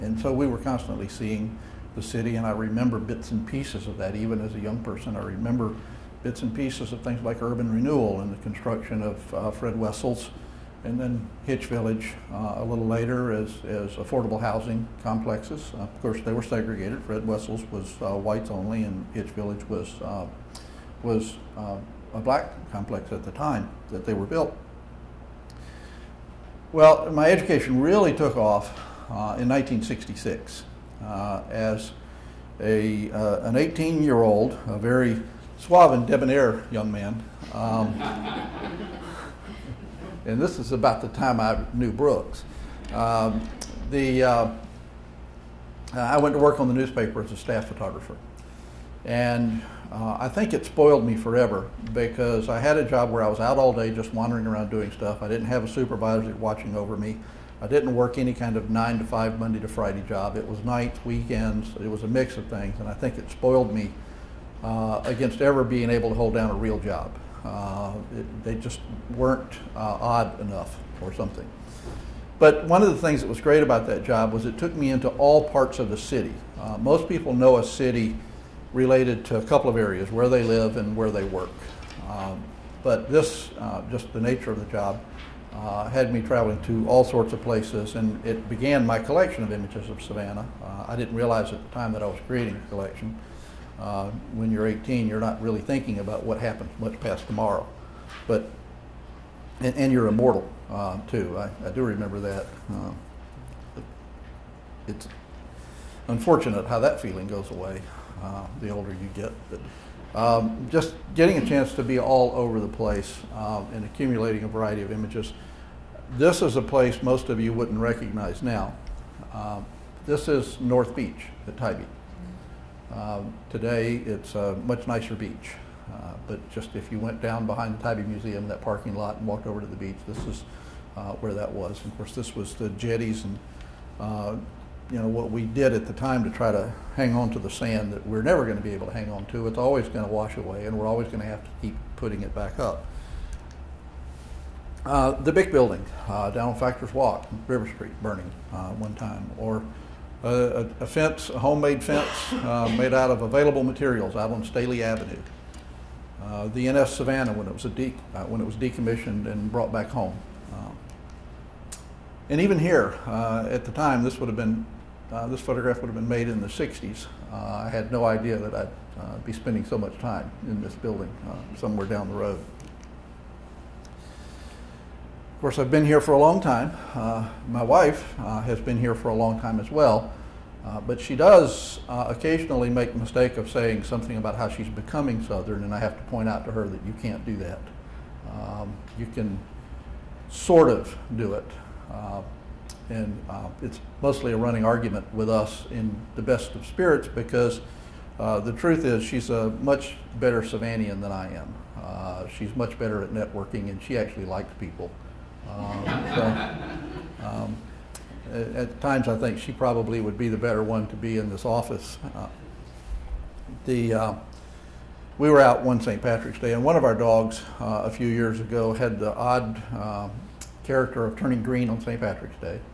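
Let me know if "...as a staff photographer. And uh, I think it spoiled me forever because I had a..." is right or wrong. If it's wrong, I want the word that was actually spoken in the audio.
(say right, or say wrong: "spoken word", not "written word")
right.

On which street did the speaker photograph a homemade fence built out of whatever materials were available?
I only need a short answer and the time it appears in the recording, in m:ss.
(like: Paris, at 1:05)
Staley Avenue, at 2:34.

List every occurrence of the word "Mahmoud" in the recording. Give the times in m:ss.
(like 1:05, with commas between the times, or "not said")
not said.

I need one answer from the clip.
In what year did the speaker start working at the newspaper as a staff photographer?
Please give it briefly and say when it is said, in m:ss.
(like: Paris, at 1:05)
1966, at 0:29.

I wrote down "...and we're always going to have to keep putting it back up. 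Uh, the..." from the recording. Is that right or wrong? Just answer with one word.
right.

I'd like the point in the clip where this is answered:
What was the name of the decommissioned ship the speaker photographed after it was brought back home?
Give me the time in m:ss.
2:36.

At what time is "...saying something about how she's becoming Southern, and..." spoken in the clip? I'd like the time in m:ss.
3:03.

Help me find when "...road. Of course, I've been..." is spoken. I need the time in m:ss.
2:52.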